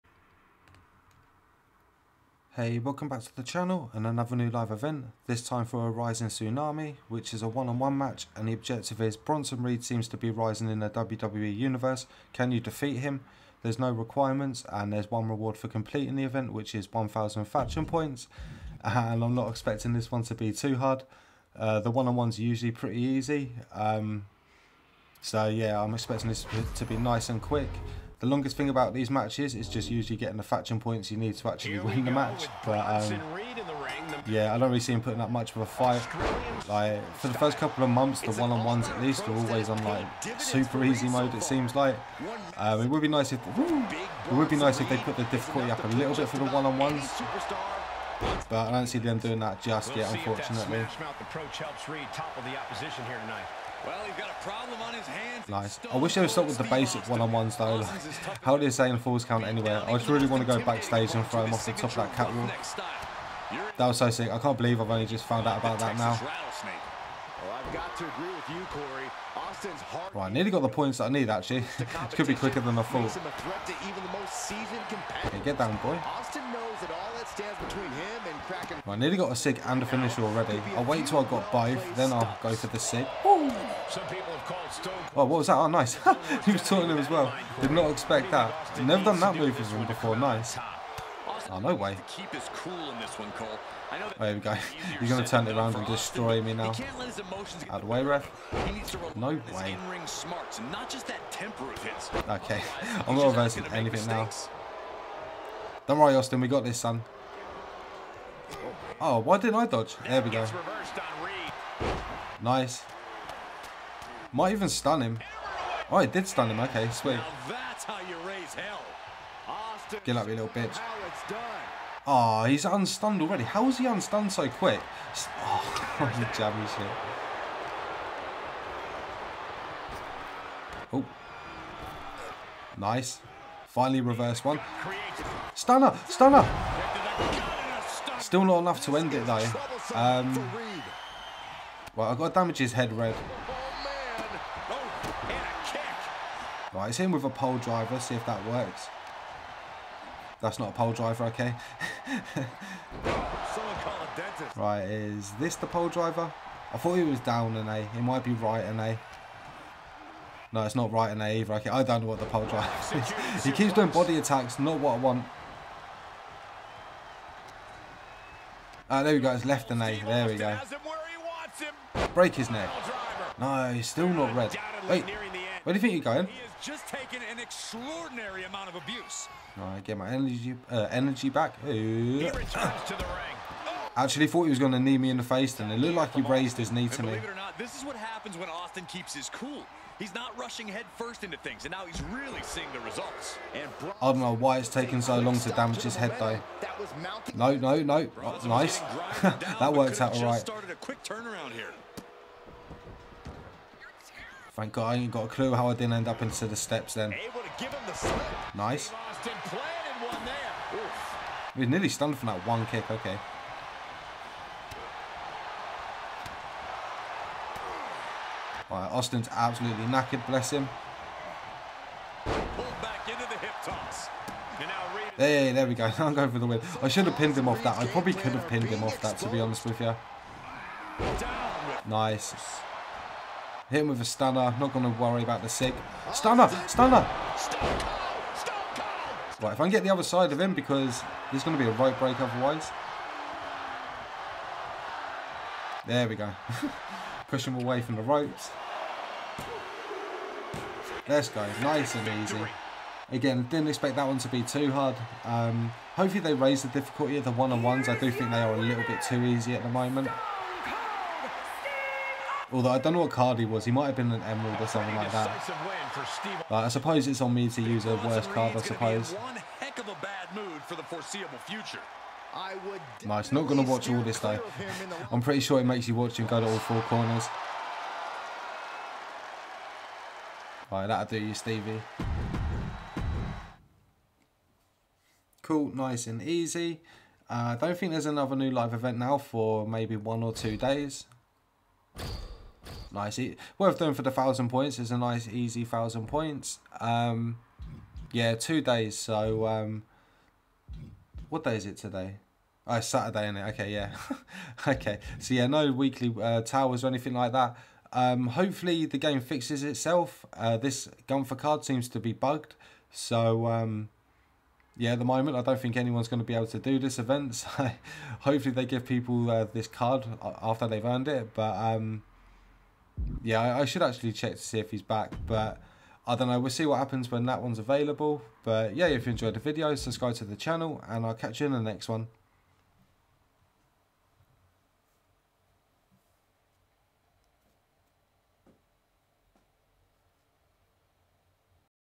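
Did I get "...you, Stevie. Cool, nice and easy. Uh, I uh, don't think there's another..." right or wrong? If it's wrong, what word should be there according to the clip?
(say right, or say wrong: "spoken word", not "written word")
right.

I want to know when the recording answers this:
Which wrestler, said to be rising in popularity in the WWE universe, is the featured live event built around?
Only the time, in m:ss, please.
0:09.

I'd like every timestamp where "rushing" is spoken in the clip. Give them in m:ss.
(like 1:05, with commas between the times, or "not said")
3:10.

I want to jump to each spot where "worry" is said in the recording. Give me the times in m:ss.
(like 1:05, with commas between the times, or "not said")
1:45, 3:55.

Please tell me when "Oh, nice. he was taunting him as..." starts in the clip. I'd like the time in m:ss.
1:25.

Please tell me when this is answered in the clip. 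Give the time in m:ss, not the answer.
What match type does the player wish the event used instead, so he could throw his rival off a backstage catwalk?
0:58.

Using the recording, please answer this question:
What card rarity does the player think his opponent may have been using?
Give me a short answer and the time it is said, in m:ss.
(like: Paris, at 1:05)
Emerald, at 4:24.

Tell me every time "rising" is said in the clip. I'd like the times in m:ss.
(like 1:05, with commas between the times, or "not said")
0:05, 0:10.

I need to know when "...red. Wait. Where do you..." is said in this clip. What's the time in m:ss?
2:54.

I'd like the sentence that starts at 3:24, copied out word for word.
Thank God I ain't got a clue how I didn't end up into the steps then.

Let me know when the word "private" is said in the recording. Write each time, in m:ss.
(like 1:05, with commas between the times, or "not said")
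not said.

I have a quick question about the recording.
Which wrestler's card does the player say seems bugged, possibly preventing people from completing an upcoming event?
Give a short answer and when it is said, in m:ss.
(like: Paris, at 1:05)
Gunther, at 5:11.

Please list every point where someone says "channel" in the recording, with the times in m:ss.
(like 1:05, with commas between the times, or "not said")
0:03, 5:30.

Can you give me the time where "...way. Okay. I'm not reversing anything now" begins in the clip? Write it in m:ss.
1:39.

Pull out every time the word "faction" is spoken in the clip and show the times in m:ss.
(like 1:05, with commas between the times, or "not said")
0:17, 0:30.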